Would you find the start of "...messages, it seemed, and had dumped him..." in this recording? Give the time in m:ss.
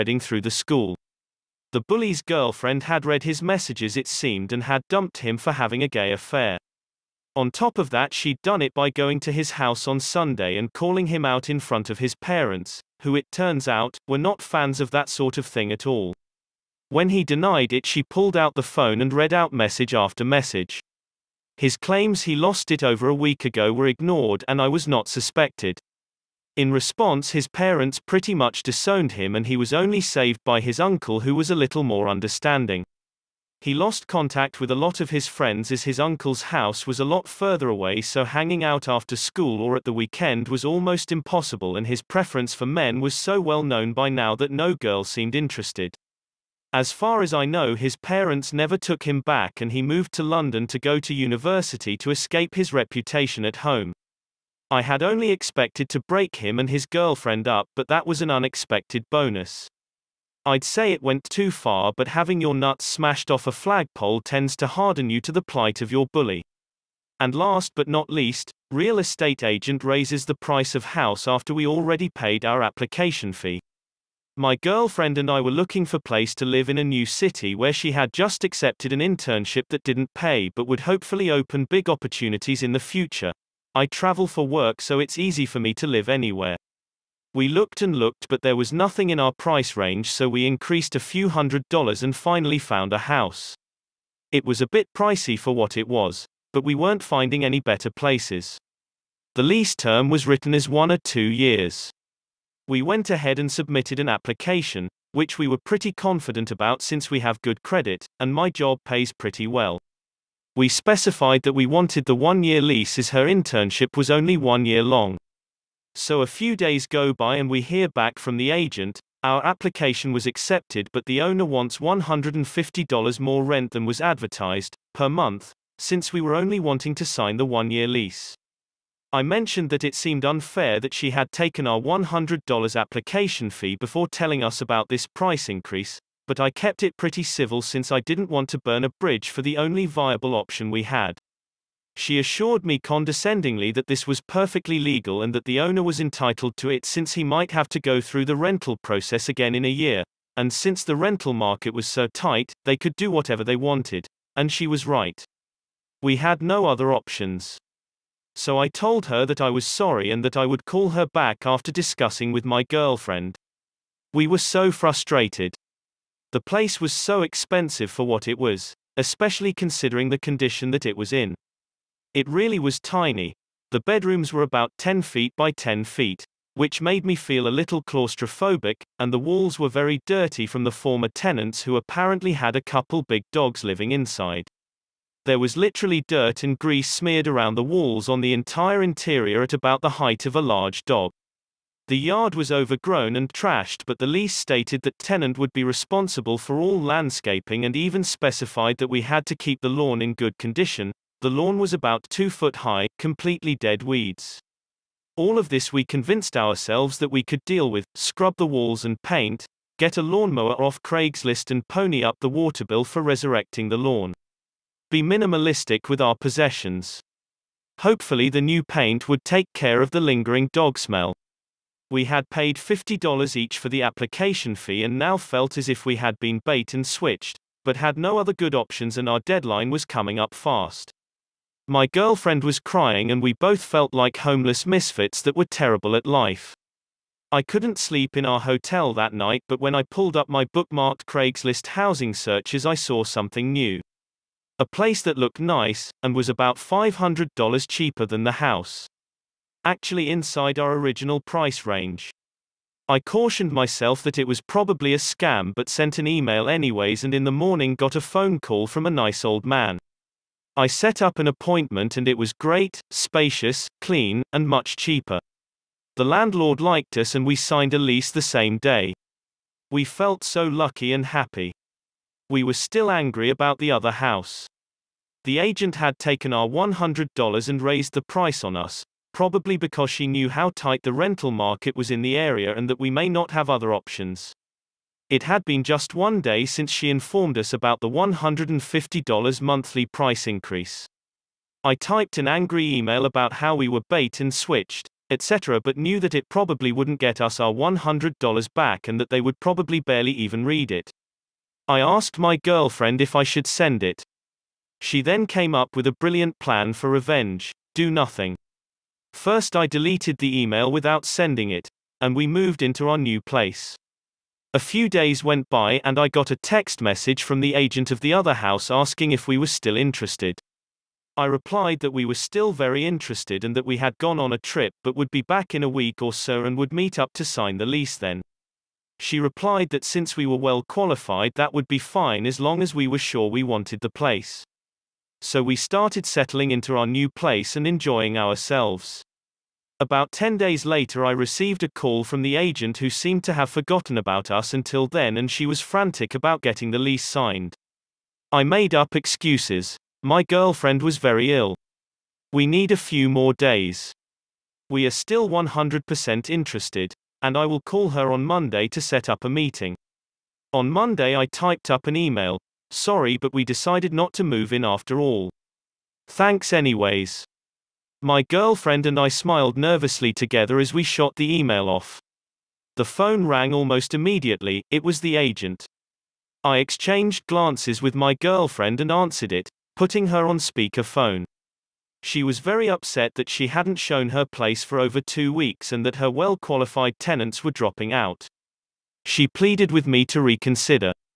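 0:03.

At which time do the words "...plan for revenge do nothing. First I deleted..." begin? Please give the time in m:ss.
5:06.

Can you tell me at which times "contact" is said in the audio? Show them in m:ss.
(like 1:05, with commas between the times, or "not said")
0:34.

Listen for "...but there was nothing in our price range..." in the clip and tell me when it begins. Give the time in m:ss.
1:28.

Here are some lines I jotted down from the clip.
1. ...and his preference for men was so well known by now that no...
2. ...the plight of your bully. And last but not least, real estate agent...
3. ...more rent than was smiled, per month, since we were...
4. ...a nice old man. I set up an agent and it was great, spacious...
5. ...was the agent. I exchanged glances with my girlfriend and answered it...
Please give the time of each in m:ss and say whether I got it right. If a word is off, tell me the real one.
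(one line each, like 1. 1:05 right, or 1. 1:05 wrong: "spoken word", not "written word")
1. 0:41 right
2. 1:05 right
3. 2:03 wrong: "advertised", not "smiled"
4. 4:18 wrong: "appointment", not "agent"
5. 6:14 right.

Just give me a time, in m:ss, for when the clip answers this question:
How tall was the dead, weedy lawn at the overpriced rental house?
3:22.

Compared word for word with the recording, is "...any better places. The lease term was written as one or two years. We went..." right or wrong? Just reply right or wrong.
right.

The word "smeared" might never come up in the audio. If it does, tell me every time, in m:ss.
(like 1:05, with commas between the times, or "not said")
3:06.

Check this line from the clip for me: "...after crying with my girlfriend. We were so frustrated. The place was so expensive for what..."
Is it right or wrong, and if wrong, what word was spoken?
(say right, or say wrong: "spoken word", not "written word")
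wrong: "discussing", not "crying".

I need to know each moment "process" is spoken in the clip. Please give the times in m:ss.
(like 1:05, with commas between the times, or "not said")
2:28.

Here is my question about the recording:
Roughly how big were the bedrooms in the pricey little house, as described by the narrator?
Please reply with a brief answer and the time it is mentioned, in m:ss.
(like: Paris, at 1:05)
10 feet by 10 feet, at 2:54.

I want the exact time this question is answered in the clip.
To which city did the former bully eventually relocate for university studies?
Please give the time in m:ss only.
0:50.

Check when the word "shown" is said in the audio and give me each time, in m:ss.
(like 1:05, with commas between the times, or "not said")
6:23.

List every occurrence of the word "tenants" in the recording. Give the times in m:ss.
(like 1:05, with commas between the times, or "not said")
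3:01, 3:14, 6:26.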